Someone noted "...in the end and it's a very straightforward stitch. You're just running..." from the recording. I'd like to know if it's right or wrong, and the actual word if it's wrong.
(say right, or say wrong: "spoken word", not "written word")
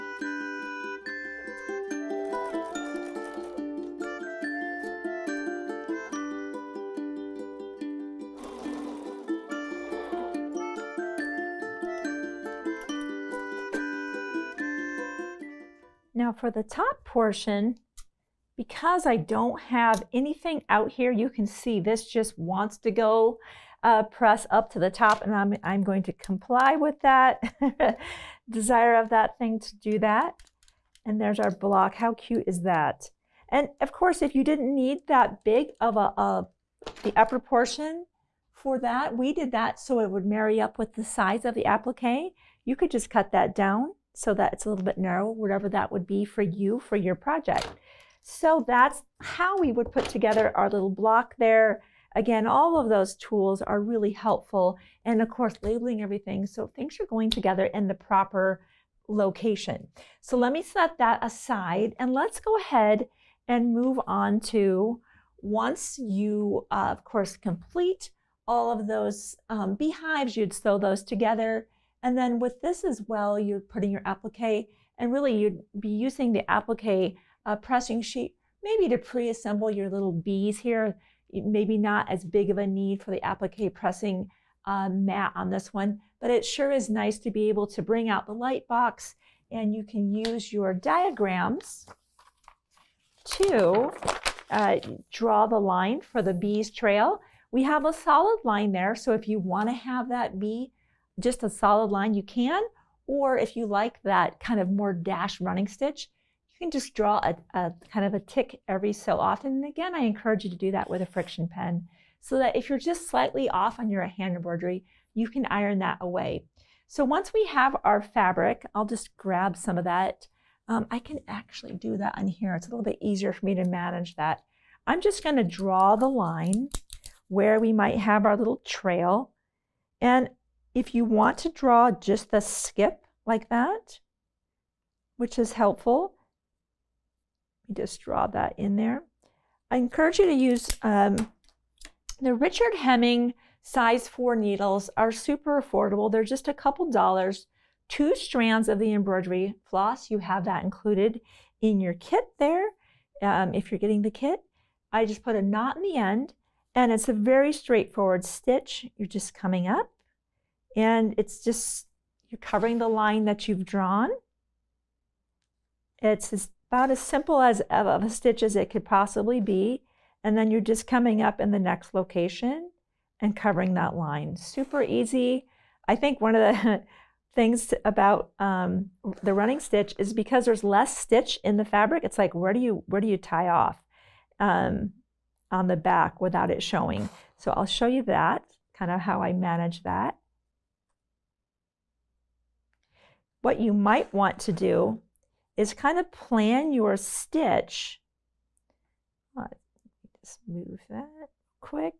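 wrong: "coming", not "running".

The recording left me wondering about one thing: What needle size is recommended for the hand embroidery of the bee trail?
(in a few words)
4.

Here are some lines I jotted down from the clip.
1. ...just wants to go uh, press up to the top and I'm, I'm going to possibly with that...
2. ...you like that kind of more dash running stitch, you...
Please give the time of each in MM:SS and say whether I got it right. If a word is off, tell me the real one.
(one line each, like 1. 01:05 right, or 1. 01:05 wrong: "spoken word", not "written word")
1. 00:22 wrong: "comply", not "possibly"
2. 01:43 right.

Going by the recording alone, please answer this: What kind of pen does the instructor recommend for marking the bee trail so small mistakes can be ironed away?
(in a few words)
friction pen.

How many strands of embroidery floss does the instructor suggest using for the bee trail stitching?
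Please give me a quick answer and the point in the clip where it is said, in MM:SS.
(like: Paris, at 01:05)
2, at 02:27.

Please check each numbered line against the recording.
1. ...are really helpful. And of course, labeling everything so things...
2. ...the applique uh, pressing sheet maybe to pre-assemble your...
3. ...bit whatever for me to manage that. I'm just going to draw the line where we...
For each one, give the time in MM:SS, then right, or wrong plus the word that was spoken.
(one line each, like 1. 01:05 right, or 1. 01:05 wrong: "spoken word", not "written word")
1. 00:53 right
2. 01:16 right
3. 02:02 wrong: "easier", not "whatever".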